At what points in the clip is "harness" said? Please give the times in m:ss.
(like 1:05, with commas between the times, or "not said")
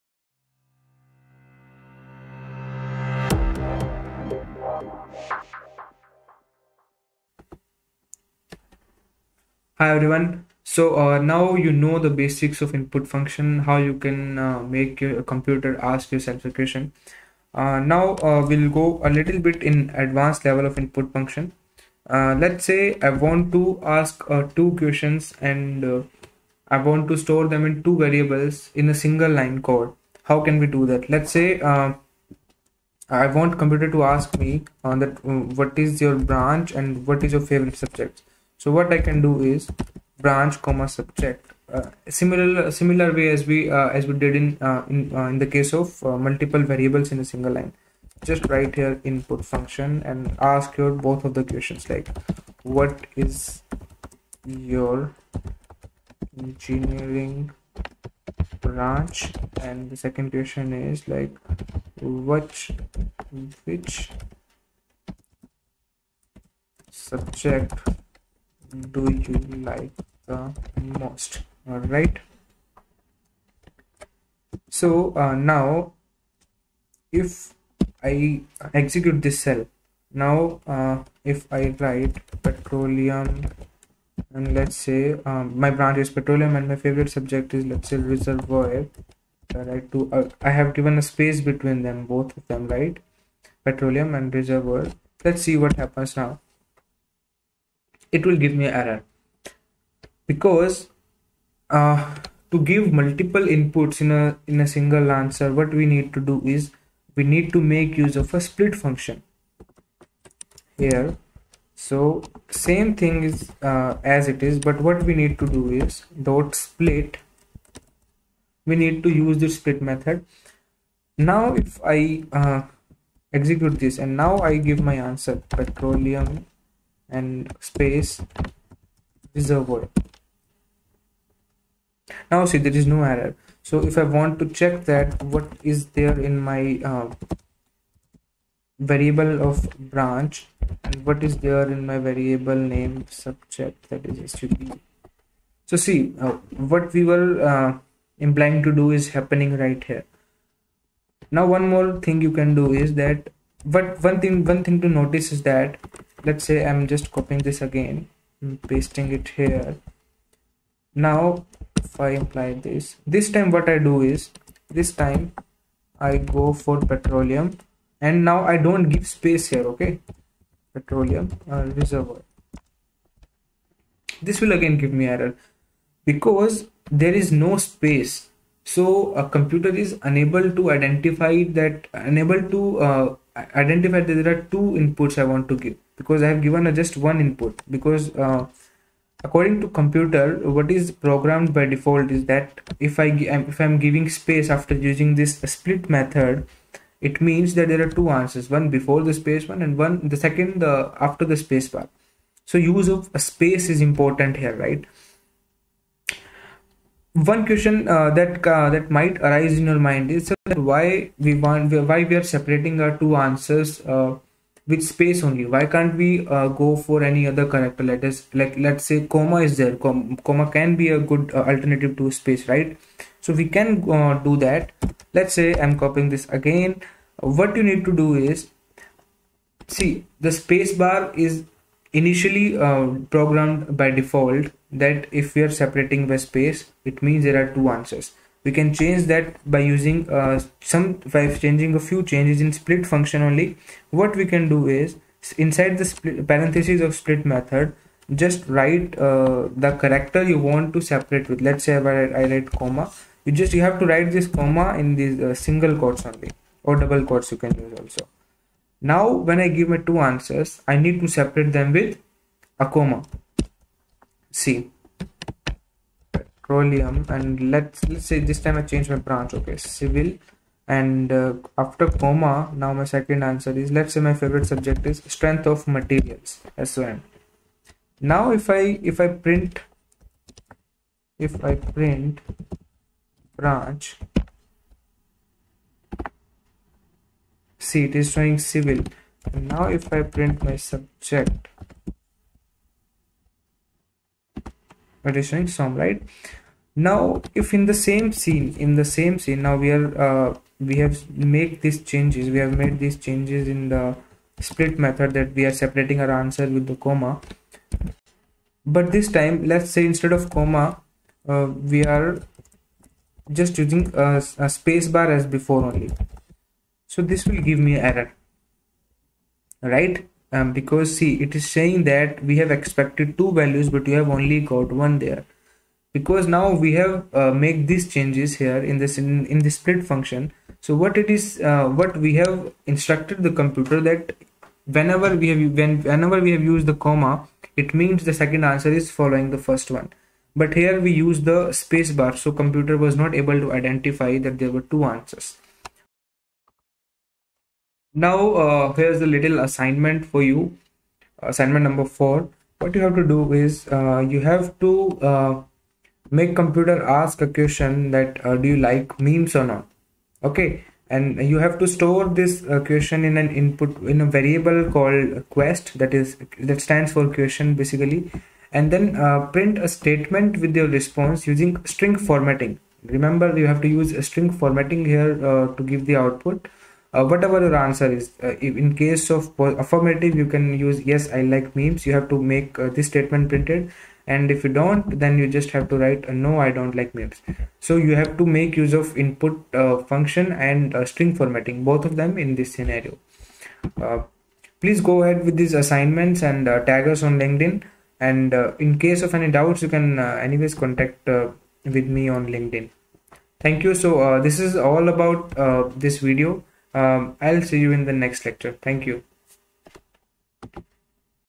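not said.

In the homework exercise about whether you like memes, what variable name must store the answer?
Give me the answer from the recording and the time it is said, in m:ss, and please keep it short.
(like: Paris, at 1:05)
quest, at 6:05.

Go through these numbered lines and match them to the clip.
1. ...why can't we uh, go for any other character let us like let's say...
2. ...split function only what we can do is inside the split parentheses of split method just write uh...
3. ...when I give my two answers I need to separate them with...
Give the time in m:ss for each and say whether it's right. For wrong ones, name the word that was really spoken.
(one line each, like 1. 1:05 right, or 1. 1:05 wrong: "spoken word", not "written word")
1. 3:35 right
2. 4:02 right
3. 4:19 right.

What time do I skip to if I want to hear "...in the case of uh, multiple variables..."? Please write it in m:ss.
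0:45.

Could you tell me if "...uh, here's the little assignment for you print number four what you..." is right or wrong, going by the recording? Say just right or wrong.
wrong.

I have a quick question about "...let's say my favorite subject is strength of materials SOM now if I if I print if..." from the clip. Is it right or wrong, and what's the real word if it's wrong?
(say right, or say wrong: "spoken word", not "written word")
right.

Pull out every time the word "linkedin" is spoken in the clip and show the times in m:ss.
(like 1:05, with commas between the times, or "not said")
6:37, 6:42.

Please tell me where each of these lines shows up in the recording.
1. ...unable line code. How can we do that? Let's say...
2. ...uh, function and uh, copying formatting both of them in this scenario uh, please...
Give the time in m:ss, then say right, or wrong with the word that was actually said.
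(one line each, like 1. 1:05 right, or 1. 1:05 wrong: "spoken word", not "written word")
1. 0:28 wrong: "single", not "unable"
2. 6:29 wrong: "string", not "copying".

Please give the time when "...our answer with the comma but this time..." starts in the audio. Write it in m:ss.
5:05.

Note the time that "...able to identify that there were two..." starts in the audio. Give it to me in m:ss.
5:43.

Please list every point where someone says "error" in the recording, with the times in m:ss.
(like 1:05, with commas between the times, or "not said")
1:38, 2:13, 2:55, 5:17.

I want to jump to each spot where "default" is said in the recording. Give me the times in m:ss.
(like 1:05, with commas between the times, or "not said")
3:11, 3:53.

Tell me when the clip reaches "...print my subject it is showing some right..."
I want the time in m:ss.
4:50.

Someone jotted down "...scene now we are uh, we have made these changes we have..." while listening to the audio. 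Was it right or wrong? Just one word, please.
right.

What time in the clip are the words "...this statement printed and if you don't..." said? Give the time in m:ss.
6:22.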